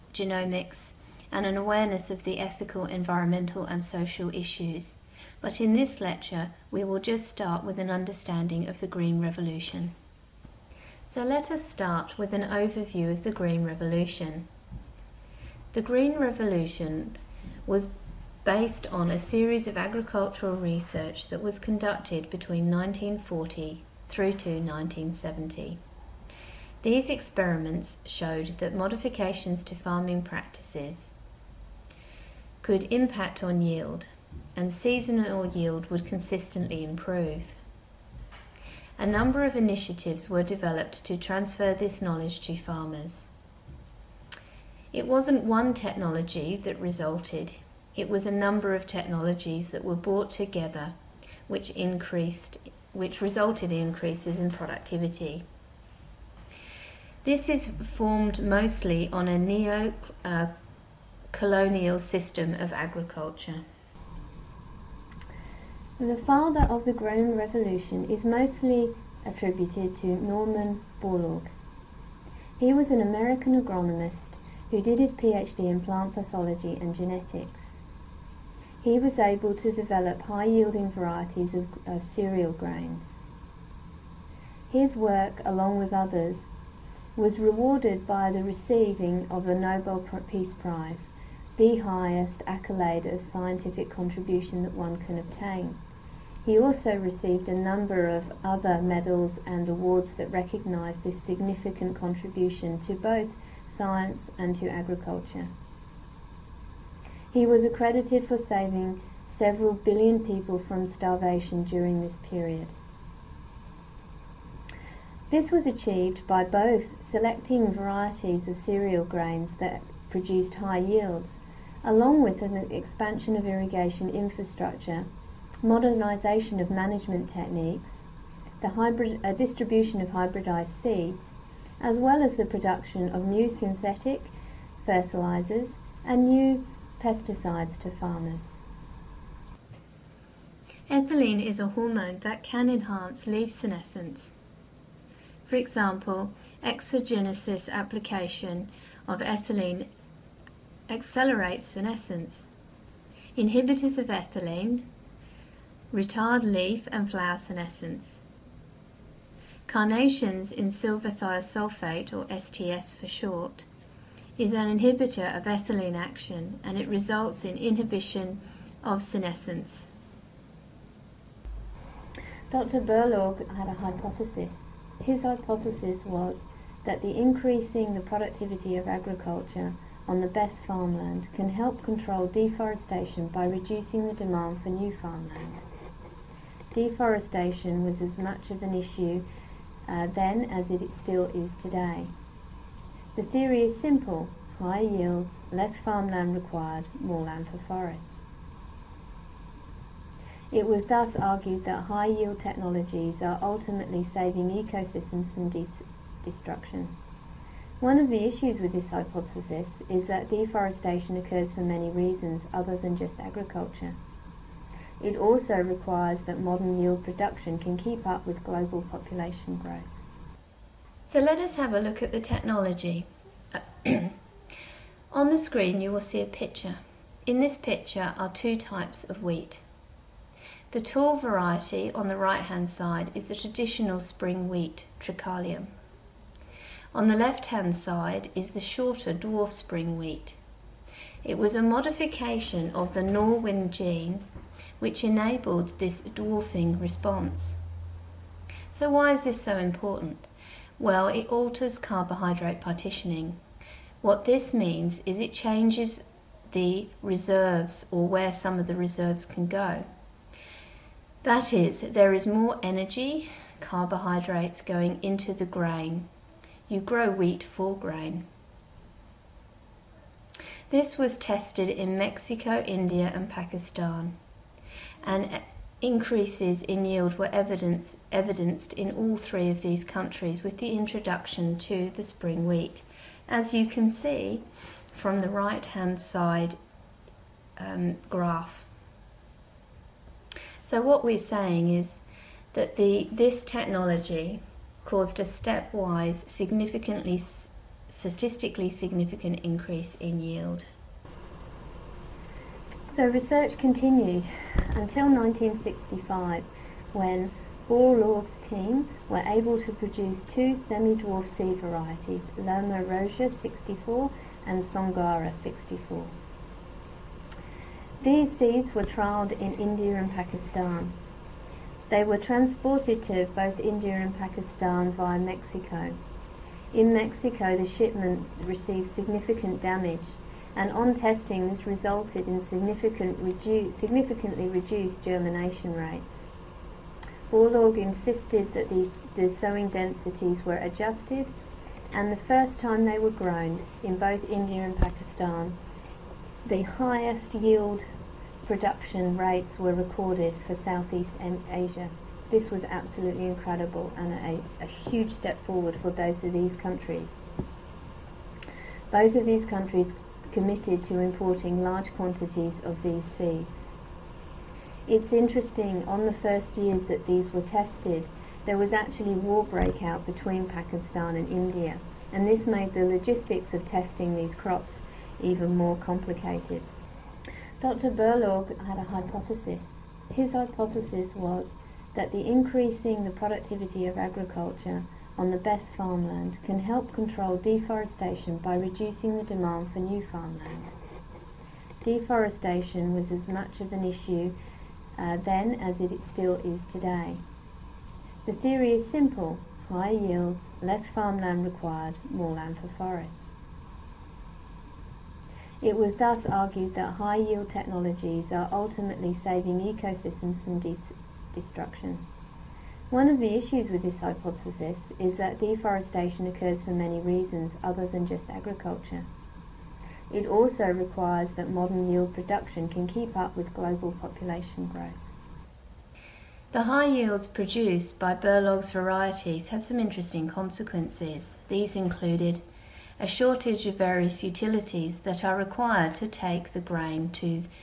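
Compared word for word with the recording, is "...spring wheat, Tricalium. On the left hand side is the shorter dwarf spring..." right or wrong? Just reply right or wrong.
right.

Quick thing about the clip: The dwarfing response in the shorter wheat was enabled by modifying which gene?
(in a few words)
Norwin gene.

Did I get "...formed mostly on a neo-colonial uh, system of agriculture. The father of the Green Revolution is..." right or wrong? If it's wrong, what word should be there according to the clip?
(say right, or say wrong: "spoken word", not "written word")
right.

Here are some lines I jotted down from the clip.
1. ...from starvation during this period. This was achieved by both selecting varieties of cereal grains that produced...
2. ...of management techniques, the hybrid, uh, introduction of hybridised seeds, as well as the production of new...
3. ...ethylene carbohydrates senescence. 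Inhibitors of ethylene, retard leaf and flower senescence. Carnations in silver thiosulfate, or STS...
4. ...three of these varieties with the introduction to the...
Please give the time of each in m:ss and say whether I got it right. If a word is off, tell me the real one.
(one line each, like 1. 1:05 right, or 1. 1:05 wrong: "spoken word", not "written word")
1. 1:50 right
2. 2:06 wrong: "distribution", not "introduction"
3. 2:29 wrong: "accelerates", not "carbohydrates"
4. 4:39 wrong: "countries", not "varieties".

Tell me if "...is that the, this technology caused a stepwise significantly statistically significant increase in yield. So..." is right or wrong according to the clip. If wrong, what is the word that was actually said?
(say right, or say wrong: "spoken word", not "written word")
right.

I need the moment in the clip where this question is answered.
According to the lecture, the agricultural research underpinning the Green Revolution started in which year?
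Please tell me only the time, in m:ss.
0:22.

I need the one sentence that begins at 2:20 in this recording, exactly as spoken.
Ethylene is a hormone that can enhance leaf senescence.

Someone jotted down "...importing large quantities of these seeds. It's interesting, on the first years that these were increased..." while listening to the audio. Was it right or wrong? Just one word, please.
wrong.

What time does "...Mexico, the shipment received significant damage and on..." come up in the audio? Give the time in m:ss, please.
5:26.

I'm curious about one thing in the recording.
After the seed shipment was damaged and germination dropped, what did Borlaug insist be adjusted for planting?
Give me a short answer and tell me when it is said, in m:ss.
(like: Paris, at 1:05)
Sowing densities, at 5:39.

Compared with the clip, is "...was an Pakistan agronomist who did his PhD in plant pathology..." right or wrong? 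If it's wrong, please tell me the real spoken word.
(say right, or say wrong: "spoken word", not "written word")
wrong: "American", not "Pakistan".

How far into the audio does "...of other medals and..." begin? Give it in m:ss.
1:38.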